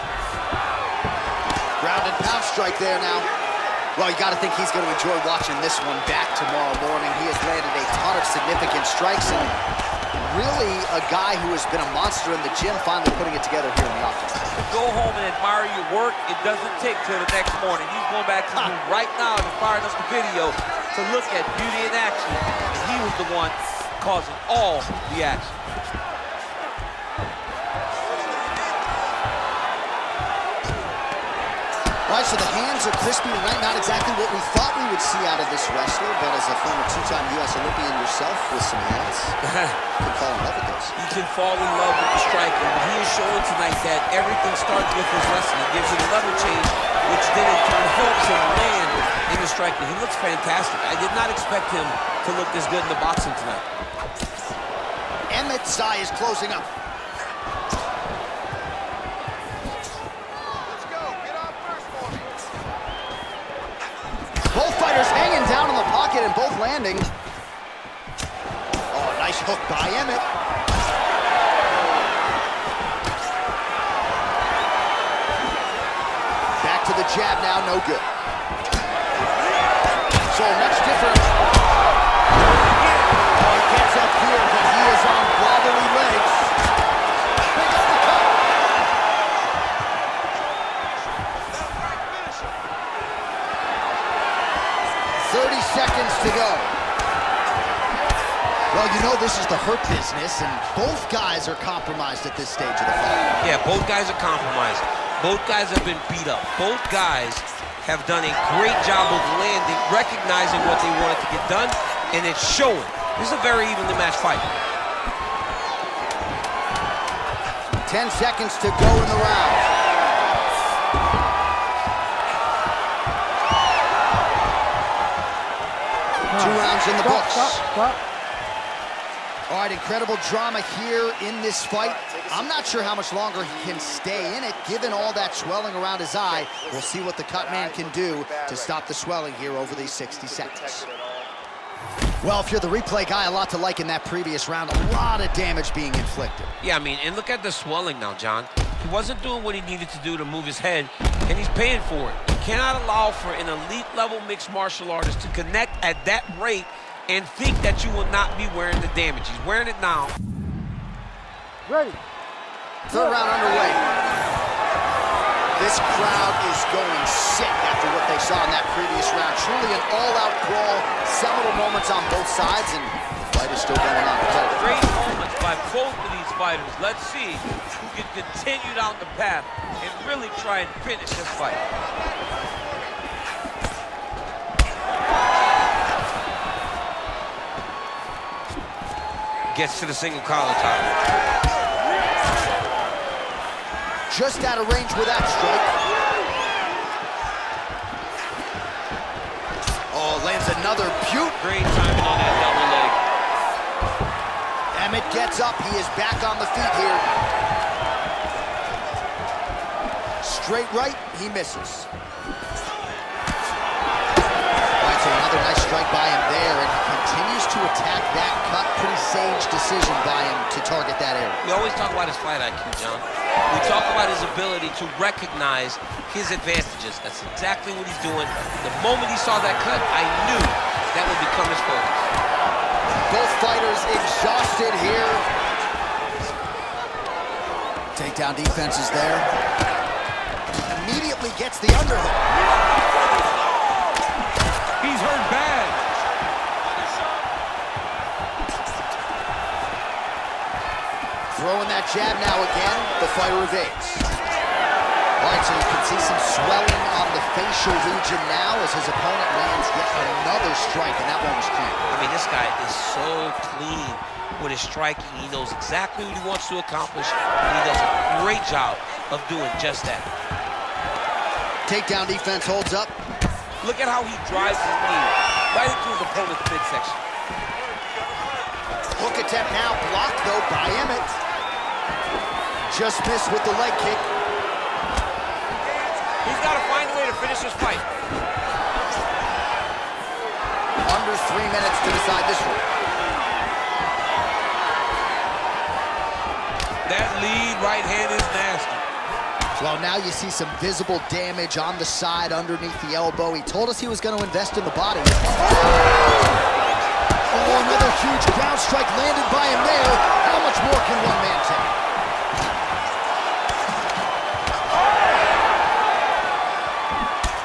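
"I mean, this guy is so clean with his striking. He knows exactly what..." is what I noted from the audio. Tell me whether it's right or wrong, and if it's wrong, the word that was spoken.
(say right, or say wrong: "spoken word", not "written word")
right.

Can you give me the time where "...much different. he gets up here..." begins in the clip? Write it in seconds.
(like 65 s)
80 s.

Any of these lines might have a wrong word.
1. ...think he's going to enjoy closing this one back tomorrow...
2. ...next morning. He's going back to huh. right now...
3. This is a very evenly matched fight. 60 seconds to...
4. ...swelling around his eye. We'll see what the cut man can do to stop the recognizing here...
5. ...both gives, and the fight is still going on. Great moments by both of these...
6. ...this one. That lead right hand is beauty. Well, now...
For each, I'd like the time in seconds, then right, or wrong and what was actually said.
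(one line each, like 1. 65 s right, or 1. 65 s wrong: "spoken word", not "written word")
1. 4 s wrong: "watching", not "closing"
2. 17 s right
3. 113 s wrong: "10", not "60"
4. 135 s wrong: "swelling", not "recognizing"
5. 172 s wrong: "sides", not "gives"
6. 292 s wrong: "nasty", not "beauty".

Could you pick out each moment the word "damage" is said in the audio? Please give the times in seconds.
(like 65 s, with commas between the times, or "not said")
145 s, 158 s, 301 s.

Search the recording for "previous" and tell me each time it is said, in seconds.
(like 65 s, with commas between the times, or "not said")
144 s, 168 s.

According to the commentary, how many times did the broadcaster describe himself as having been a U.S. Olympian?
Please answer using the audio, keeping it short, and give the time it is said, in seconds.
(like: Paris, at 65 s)
2, at 36 s.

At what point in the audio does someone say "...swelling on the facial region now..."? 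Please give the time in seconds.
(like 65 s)
256 s.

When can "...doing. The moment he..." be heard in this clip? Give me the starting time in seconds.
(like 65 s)
228 s.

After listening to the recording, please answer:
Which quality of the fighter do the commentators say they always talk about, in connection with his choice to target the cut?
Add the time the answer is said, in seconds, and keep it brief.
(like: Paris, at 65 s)
Fight IQ, at 222 s.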